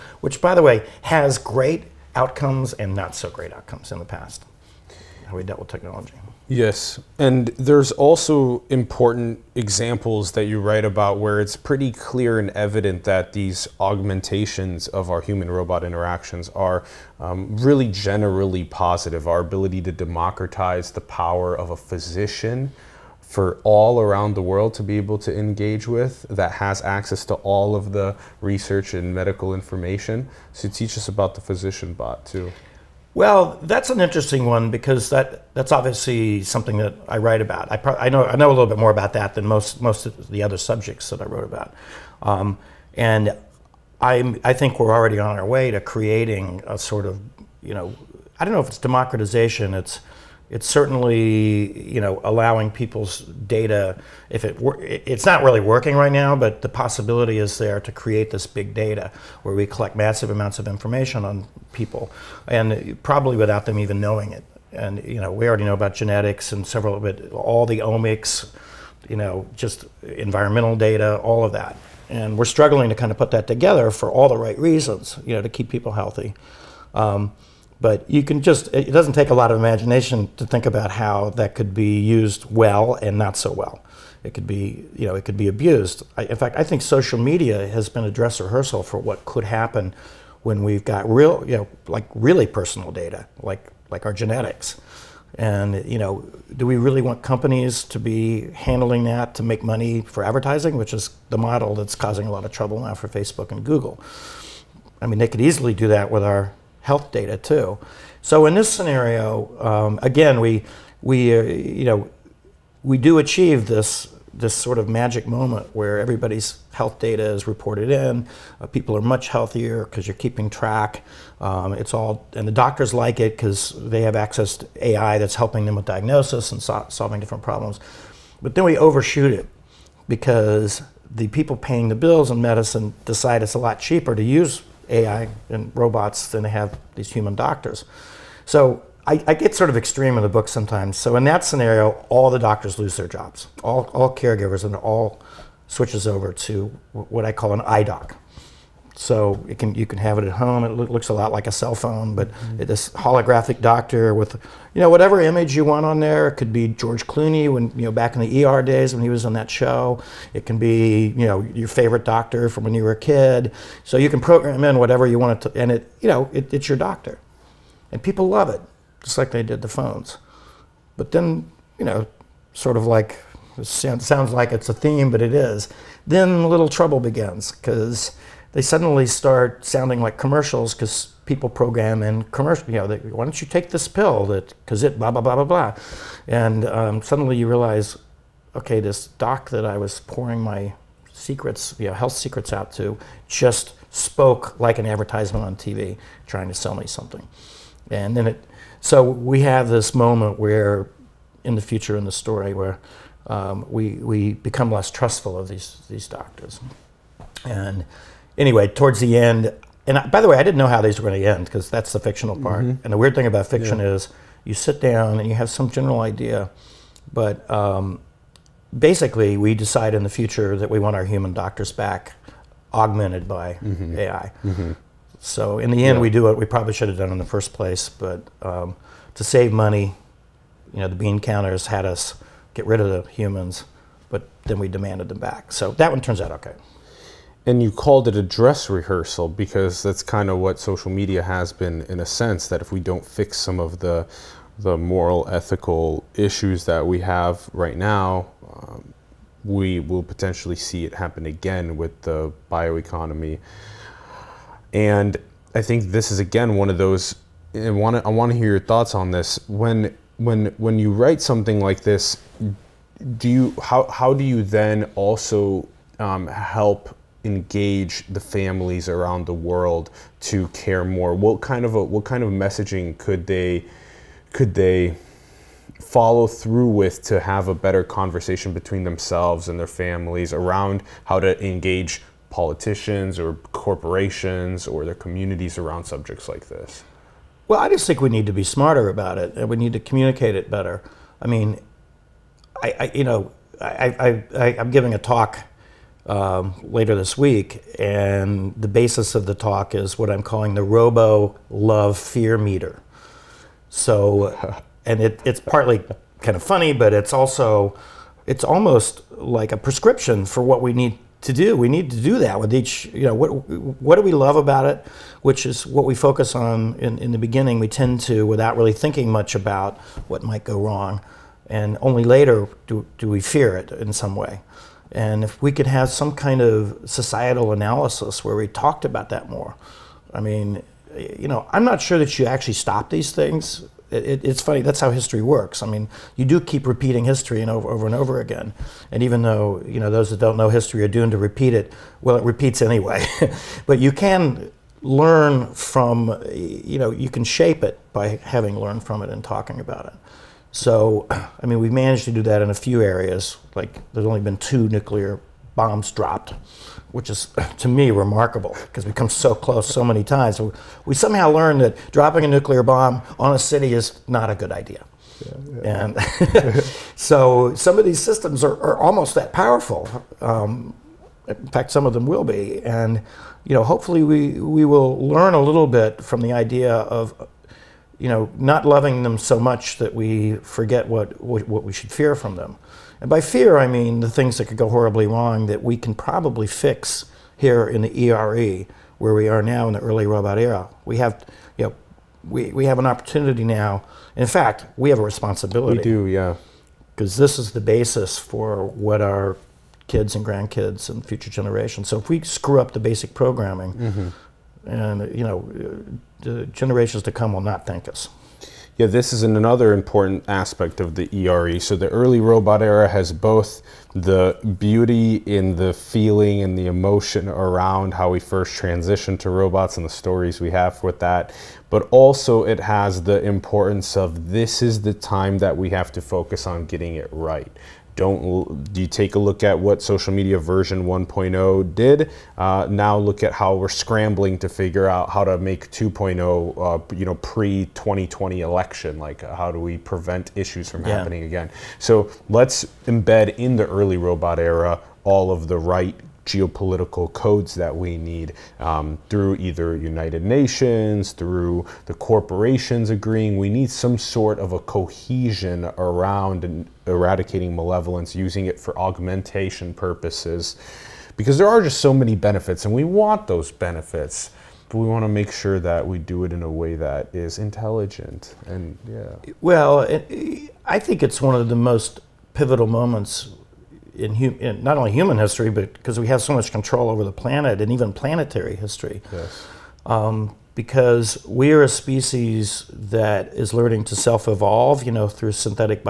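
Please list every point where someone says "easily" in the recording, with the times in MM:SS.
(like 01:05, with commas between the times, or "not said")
01:45.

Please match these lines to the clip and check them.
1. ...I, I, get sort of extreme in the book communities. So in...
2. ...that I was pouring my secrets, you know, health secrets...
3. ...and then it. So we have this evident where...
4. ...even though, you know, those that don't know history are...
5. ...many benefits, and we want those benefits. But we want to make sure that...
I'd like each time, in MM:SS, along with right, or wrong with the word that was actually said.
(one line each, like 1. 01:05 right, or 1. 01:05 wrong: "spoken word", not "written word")
1. 02:19 wrong: "sometimes", not "communities"
2. 03:09 right
3. 03:17 wrong: "moment", not "evident"
4. 05:39 right
5. 07:41 right.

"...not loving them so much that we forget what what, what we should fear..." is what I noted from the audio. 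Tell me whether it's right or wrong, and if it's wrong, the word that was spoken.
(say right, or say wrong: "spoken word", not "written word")
right.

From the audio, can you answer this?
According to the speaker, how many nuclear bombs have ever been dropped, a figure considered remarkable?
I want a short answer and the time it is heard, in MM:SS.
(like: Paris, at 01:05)
2, at 05:54.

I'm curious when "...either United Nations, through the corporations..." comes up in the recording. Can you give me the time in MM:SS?
07:29.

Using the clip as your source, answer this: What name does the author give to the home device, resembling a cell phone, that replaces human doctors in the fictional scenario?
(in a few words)
IDOC.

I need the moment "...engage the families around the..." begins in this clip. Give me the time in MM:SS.
04:27.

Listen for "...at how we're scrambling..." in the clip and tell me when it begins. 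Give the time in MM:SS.
07:13.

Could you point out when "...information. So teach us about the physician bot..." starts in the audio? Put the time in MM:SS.
00:29.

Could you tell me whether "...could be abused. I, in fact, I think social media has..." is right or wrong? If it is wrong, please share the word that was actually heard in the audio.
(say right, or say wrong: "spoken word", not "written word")
right.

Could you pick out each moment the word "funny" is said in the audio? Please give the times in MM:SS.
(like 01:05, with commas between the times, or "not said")
05:06, 05:34.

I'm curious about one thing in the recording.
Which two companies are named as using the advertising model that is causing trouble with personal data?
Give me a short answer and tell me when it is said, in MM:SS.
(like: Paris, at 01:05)
Facebook and Google, at 01:43.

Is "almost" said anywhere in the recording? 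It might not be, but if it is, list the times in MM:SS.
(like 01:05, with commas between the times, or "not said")
05:08, 06:08.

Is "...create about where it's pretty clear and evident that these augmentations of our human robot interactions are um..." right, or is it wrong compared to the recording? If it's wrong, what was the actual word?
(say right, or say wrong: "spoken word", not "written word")
wrong: "write", not "create".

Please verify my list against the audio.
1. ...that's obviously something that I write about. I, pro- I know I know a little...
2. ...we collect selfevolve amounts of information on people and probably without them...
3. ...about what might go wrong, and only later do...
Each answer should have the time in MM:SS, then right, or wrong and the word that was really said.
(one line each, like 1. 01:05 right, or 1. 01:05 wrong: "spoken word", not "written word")
1. 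00:35 right
2. 00:59 wrong: "massive", not "selfevolve"
3. 05:19 right.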